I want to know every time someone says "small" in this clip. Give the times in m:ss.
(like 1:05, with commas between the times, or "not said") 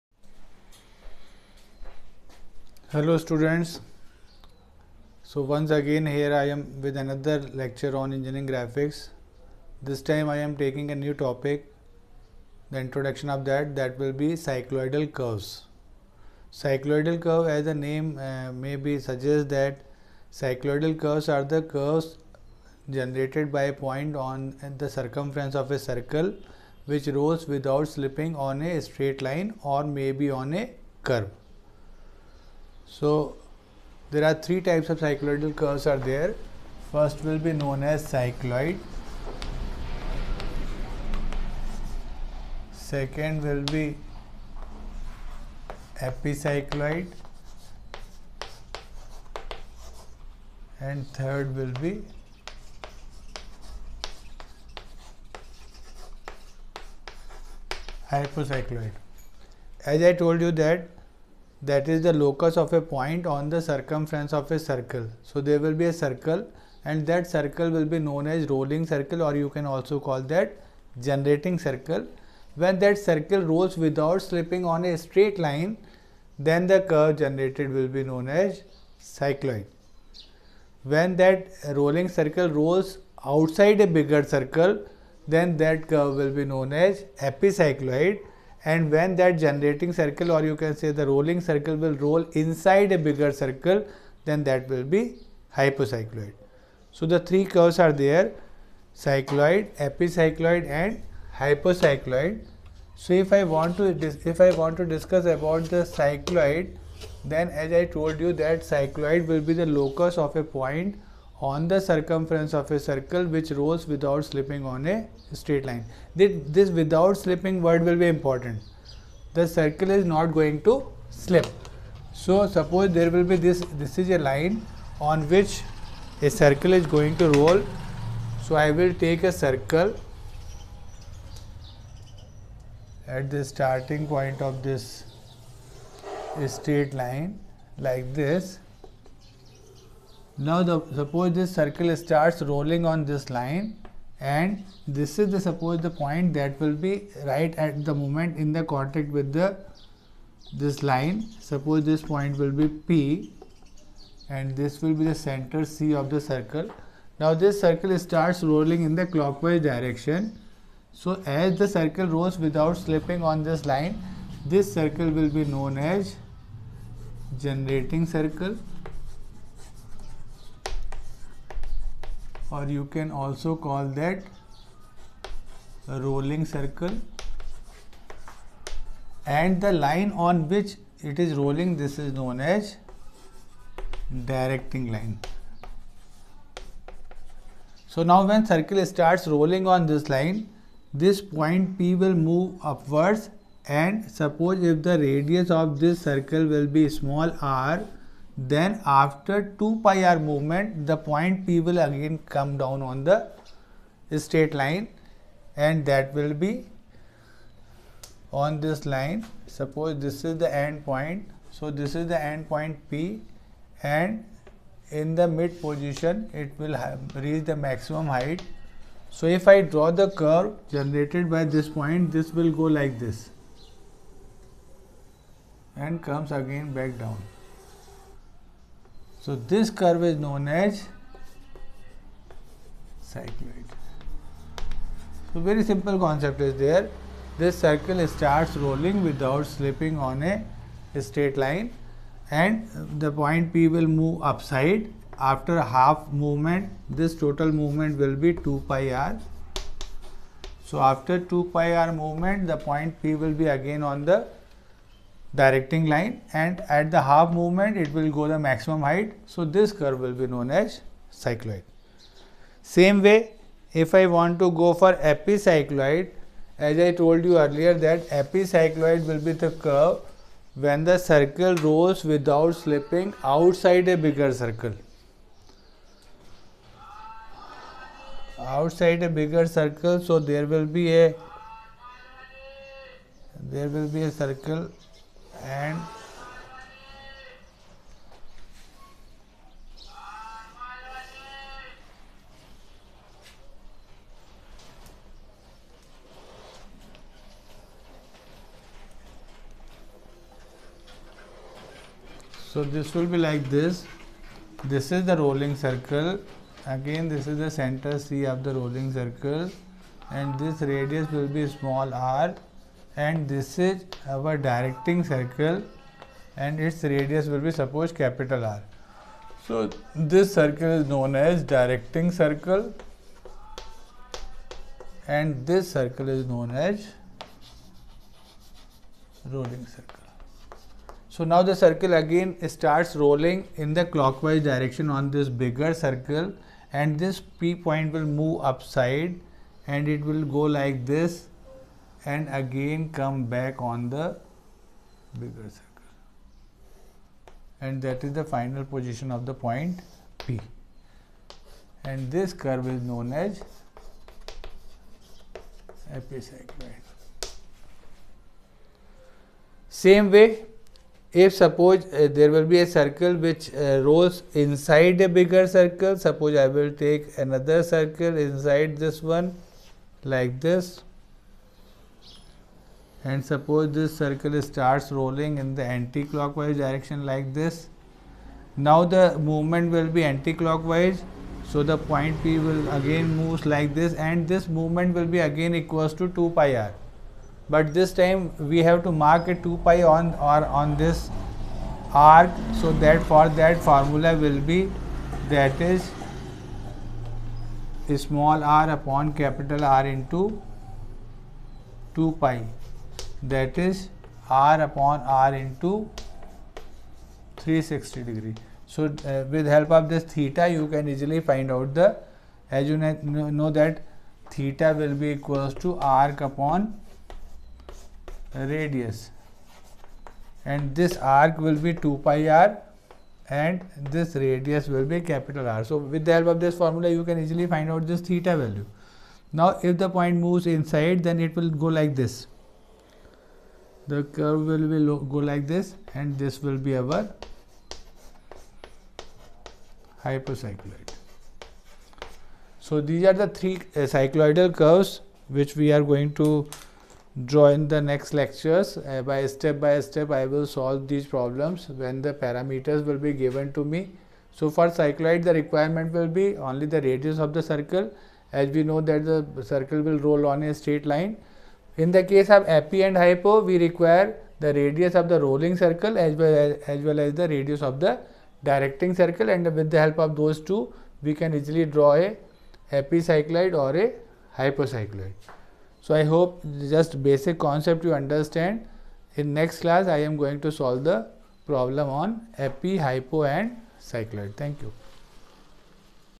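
3:16, 5:11, 6:38.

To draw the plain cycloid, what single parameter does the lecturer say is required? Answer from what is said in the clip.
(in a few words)
radius of the circle.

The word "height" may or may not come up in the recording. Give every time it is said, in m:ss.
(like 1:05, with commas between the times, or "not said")
3:38, 4:18.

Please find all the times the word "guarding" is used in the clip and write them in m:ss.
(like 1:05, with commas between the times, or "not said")
not said.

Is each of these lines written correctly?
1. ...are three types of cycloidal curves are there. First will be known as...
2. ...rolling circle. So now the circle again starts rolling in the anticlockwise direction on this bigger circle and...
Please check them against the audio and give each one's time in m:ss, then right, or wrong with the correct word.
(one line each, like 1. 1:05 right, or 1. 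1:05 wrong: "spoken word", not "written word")
1. 0:34 right
2. 5:29 wrong: "clockwise", not "anticlockwise".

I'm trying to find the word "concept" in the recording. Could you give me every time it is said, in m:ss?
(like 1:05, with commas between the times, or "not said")
3:55, 7:57.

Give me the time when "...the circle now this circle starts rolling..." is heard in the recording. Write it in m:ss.
2:36.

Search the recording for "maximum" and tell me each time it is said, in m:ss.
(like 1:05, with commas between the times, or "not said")
3:37, 4:18.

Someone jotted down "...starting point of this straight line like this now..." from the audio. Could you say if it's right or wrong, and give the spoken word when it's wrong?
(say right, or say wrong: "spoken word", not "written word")
right.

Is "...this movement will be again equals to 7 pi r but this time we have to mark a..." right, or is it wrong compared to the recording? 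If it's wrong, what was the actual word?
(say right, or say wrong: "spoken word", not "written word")
wrong: "2", not "7".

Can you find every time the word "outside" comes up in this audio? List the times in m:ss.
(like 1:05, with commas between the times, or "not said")
1:23, 4:33, 4:38.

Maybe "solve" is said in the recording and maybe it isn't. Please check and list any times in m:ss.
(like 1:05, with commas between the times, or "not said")
7:30, 8:00.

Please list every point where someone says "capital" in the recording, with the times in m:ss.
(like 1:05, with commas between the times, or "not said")
5:17, 6:39, 7:04.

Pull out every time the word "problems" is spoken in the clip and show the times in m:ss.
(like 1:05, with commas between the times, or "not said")
7:31, 8:01.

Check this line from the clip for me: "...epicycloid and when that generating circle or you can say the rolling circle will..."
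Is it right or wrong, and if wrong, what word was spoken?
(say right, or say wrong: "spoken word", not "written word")
right.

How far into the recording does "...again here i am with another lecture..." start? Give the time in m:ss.
0:05.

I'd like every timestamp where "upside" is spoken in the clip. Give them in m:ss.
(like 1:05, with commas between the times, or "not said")
4:04, 5:38.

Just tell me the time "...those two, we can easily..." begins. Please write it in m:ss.
7:50.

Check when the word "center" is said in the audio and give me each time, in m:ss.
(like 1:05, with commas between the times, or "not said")
2:35, 5:07.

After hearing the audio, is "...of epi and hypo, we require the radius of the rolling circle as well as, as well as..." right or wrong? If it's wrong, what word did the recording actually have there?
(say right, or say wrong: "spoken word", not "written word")
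right.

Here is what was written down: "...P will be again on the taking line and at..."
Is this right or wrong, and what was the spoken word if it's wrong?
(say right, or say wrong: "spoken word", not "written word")
wrong: "directing", not "taking".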